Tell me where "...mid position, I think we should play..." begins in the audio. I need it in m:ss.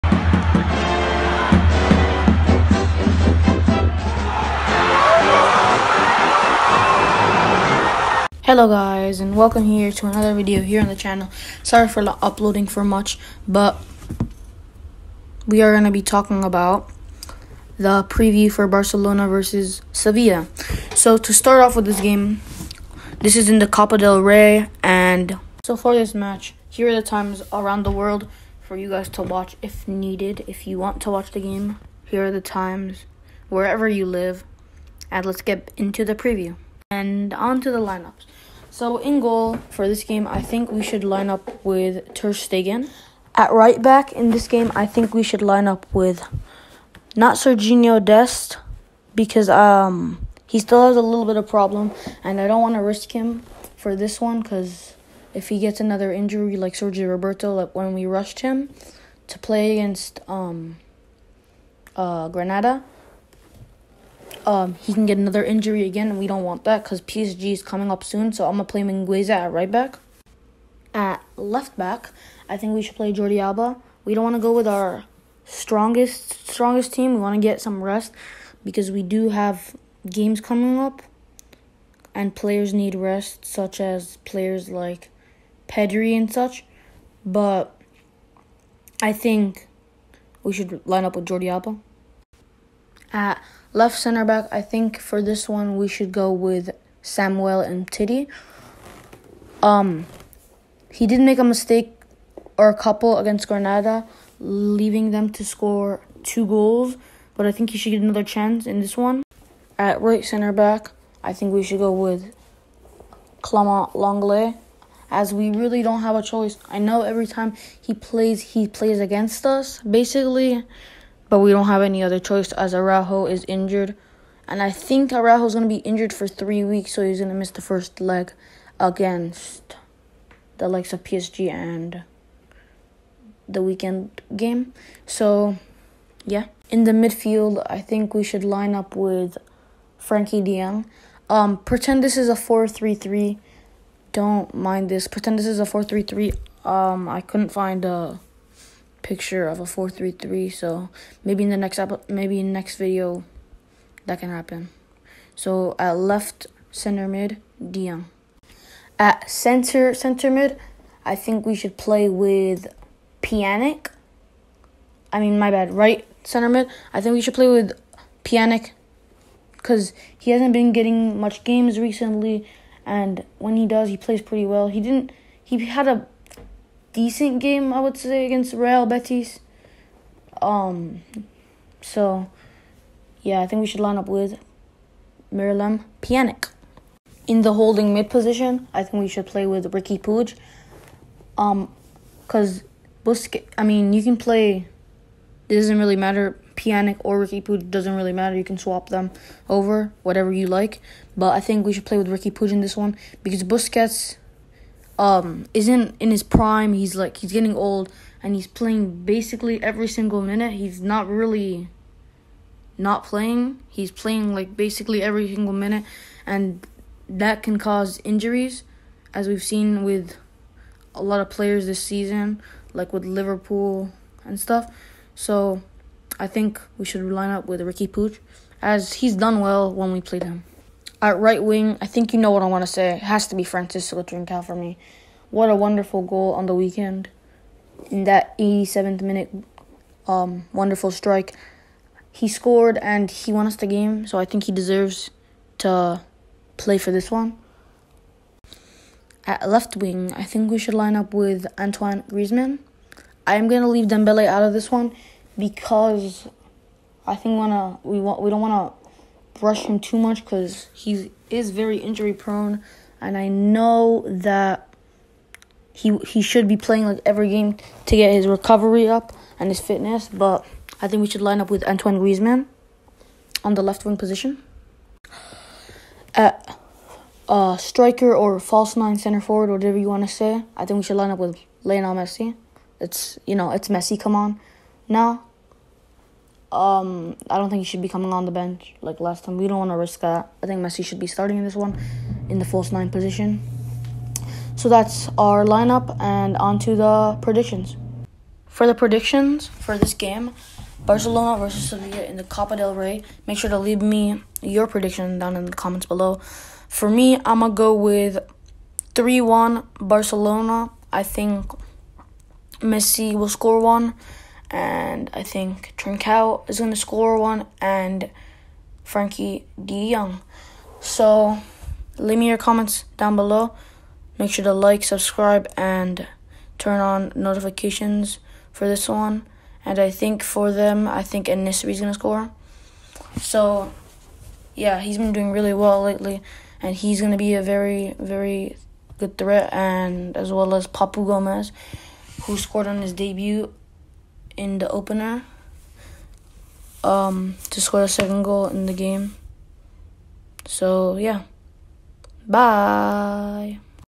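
3:07.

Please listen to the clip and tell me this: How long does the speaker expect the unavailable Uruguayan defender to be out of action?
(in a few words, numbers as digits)
3 weeks.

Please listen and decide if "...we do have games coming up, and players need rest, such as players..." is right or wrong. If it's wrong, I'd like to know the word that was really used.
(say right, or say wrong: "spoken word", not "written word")
right.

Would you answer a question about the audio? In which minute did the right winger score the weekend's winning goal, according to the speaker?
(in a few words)
87th.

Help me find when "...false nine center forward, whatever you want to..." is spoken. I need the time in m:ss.
4:38.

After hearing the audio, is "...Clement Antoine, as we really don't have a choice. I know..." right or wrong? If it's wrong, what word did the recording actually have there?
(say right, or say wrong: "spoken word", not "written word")
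wrong: "Lenglet", not "Antoine".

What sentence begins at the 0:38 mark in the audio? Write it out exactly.
So in goal for this game, I think we should line up with Ter Stegen.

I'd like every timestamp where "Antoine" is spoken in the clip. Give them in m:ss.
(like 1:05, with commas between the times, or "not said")
4:11, 4:31.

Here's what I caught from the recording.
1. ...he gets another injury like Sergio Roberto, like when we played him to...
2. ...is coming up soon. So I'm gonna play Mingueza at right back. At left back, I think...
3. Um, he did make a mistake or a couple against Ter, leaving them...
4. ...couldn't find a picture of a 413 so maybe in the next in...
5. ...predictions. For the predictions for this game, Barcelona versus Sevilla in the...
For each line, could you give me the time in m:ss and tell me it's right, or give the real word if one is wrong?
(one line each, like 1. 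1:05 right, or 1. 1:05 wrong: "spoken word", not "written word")
1. 0:55 wrong: "rushed", not "played"
2. 1:07 right
3. 1:39 wrong: "Granada", not "Ter"
4. 2:27 wrong: "433", not "413"
5. 4:57 right.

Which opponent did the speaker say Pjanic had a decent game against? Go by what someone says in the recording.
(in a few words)
Real Betis.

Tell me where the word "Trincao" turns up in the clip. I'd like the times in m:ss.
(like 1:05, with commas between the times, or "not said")
3:54, 5:15.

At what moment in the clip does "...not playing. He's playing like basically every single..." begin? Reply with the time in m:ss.
3:32.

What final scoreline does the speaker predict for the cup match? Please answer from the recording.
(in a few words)
3-1 Barcelona.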